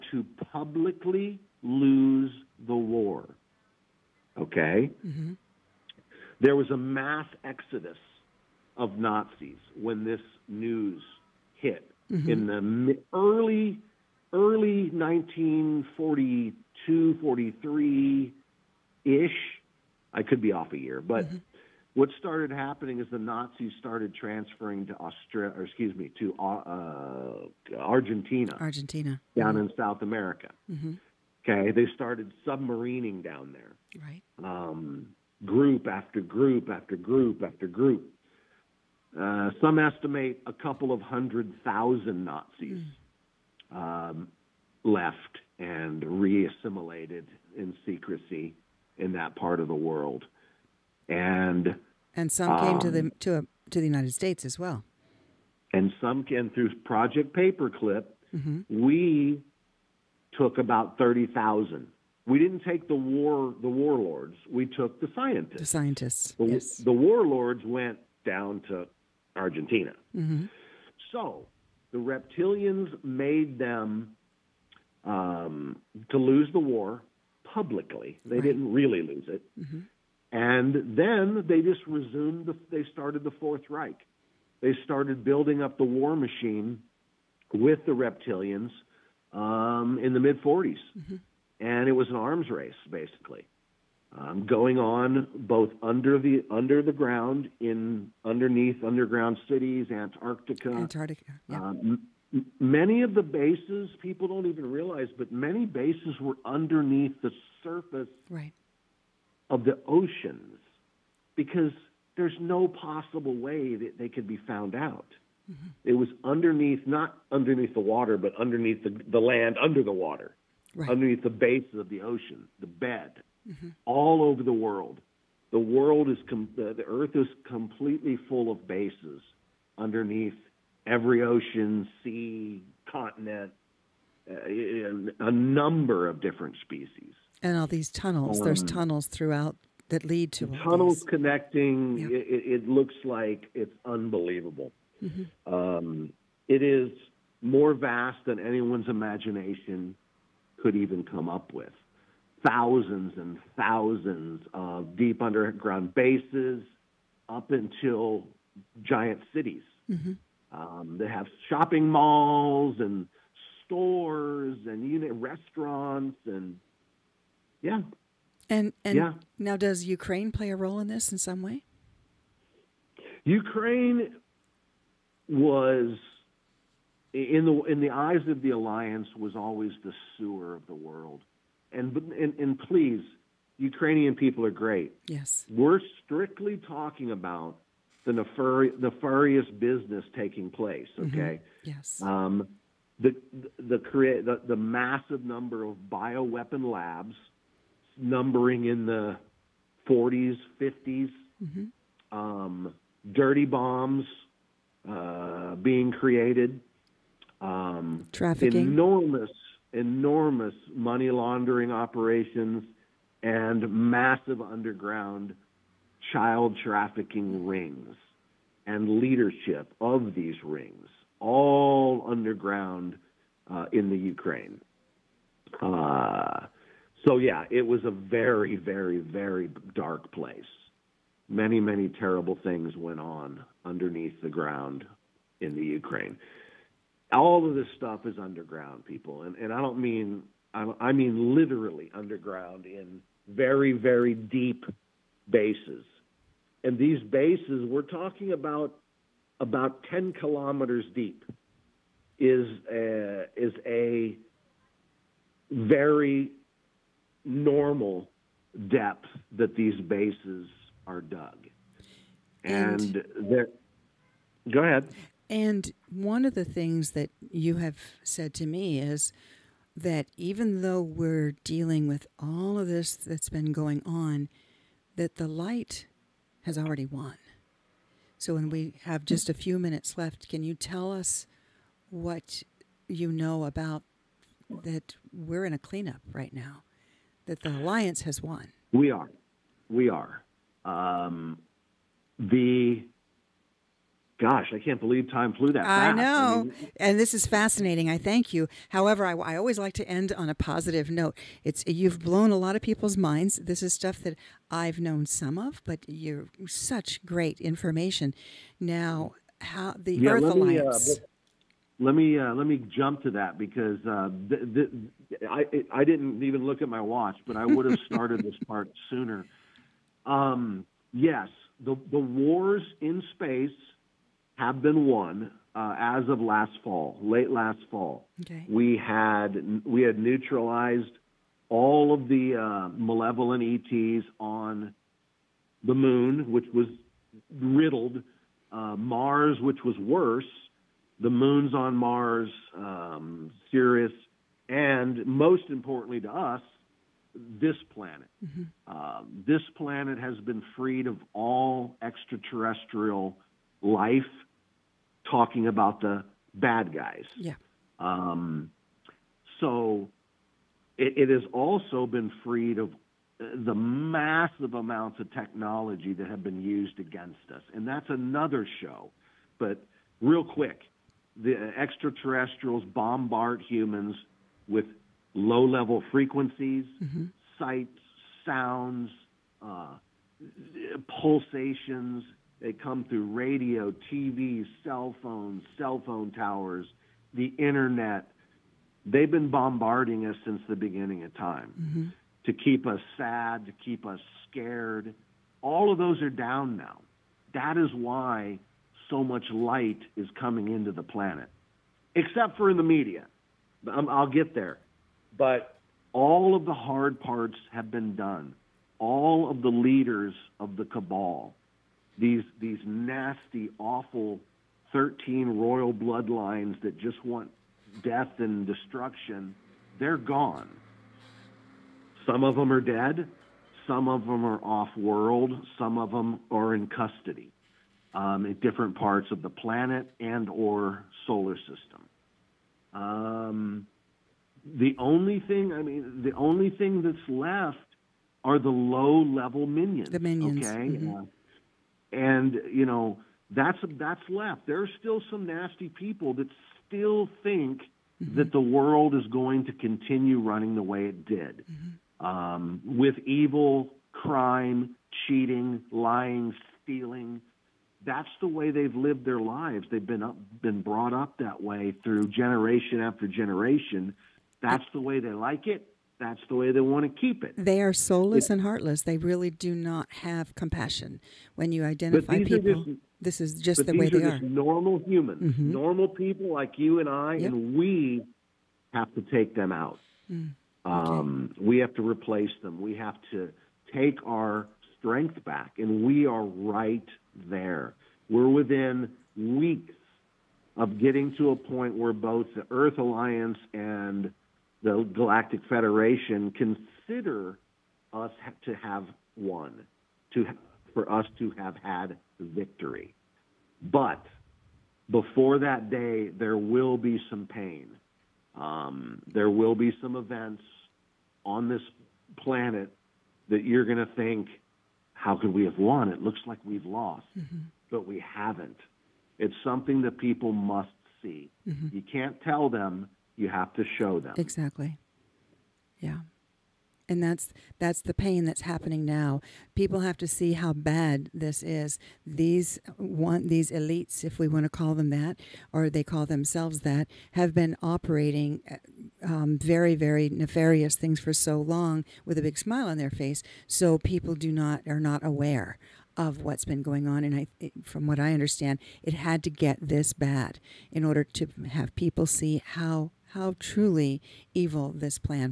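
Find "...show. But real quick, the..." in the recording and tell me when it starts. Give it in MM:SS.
06:08.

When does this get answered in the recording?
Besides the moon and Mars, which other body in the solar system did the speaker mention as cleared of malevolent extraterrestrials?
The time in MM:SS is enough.
05:43.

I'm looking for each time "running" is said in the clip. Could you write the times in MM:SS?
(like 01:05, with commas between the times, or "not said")
07:30.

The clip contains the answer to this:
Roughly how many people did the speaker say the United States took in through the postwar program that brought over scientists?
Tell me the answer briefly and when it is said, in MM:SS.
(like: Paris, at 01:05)
30,000, at 01:00.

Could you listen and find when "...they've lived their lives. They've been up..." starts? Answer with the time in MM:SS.
07:38.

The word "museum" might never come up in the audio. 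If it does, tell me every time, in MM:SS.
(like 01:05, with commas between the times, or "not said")
not said.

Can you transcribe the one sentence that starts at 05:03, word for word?
This is stuff that I've known some of, but you're such great information.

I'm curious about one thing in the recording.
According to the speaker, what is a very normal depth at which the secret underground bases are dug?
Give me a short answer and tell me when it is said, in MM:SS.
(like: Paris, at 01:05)
10 kilometers, at 04:09.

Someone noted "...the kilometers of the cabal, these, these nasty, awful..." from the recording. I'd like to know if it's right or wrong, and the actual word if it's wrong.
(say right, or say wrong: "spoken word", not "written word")
wrong: "leaders", not "kilometers".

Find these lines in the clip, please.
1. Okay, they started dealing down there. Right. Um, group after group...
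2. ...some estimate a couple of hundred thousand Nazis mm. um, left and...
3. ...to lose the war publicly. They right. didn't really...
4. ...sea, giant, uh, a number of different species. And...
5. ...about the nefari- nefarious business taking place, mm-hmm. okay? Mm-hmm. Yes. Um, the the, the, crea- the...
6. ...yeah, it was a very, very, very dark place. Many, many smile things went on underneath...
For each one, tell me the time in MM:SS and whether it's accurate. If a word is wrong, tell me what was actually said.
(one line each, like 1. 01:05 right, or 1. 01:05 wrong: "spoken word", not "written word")
1. 00:31 wrong: "submarining", not "dealing"
2. 00:39 right
3. 01:16 right
4. 02:12 wrong: "continent", not "giant"
5. 03:07 right
6. 03:47 wrong: "terrible", not "smile".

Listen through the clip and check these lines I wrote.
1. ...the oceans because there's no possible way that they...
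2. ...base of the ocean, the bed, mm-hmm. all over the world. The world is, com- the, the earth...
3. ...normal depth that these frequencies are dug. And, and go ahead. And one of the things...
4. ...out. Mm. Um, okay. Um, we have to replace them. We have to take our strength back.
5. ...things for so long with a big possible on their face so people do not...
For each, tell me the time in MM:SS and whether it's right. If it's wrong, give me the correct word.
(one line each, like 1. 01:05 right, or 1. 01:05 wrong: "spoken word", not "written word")
1. 01:49 right
2. 02:01 right
3. 04:17 wrong: "bases", not "frequencies"
4. 07:59 right
5. 09:00 wrong: "smile", not "possible".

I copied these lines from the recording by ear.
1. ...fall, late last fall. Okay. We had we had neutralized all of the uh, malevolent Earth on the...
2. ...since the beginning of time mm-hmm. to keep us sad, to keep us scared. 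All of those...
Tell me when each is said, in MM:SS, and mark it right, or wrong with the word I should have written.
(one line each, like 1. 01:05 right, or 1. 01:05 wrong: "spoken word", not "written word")
1. 05:26 wrong: "ETs", not "Earth"
2. 06:30 right.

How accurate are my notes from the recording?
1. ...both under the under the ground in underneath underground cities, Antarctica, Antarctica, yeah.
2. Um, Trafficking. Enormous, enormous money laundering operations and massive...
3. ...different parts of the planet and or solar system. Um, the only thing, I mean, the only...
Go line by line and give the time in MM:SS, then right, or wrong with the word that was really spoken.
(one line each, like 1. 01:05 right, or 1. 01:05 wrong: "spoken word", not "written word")
1. 01:35 right
2. 03:27 right
3. 07:08 right.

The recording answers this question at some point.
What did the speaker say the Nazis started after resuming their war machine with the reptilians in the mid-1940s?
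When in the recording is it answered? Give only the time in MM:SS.
01:23.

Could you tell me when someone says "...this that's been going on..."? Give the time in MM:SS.
04:32.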